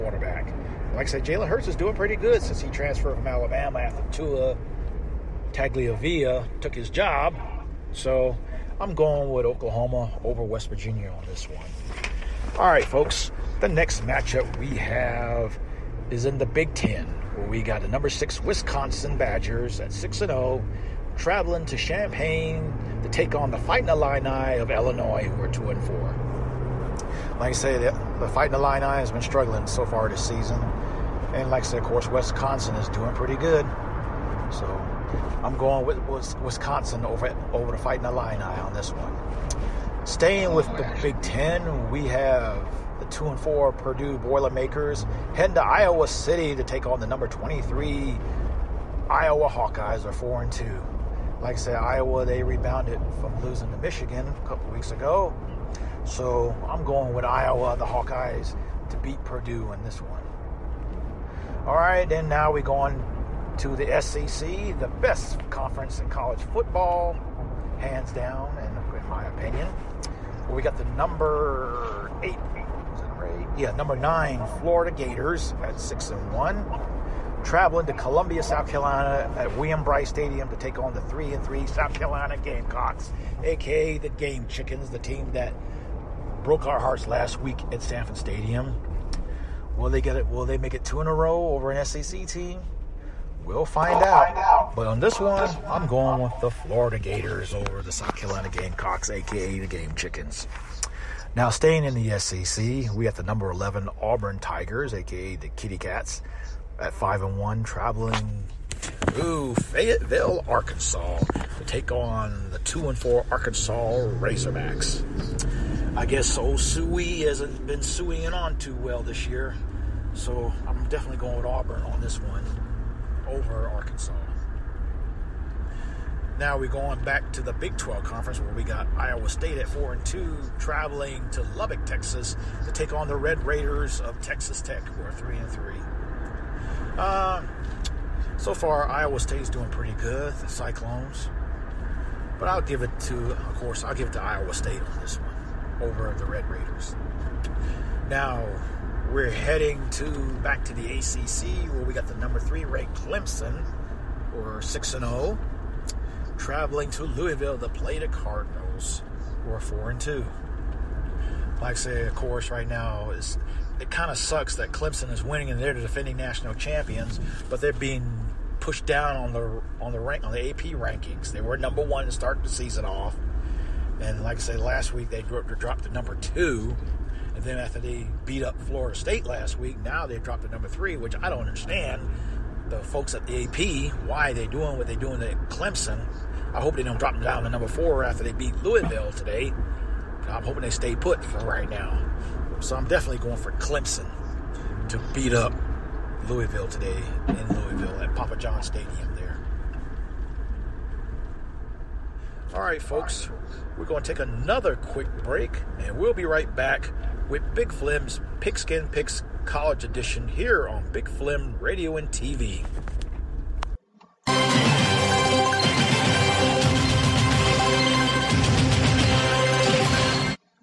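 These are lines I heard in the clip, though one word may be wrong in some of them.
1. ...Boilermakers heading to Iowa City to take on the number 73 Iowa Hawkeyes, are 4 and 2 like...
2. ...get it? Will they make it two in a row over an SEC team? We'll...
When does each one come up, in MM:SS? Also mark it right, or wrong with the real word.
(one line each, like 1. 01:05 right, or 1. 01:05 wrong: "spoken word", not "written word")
1. 00:44 wrong: "23", not "73"
2. 01:30 right.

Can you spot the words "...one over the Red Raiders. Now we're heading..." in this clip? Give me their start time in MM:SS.
02:25.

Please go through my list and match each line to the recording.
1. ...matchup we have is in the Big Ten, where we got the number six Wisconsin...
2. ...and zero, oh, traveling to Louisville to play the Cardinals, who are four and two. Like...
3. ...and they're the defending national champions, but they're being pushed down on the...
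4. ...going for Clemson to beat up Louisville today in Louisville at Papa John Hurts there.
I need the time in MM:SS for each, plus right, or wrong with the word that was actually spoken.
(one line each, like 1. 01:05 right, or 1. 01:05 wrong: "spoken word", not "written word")
1. 00:14 right
2. 02:34 right
3. 02:45 right
4. 03:13 wrong: "Stadium", not "Hurts".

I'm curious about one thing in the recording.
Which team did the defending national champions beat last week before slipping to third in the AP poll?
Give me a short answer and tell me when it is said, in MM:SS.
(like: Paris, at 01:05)
Florida State, at 02:58.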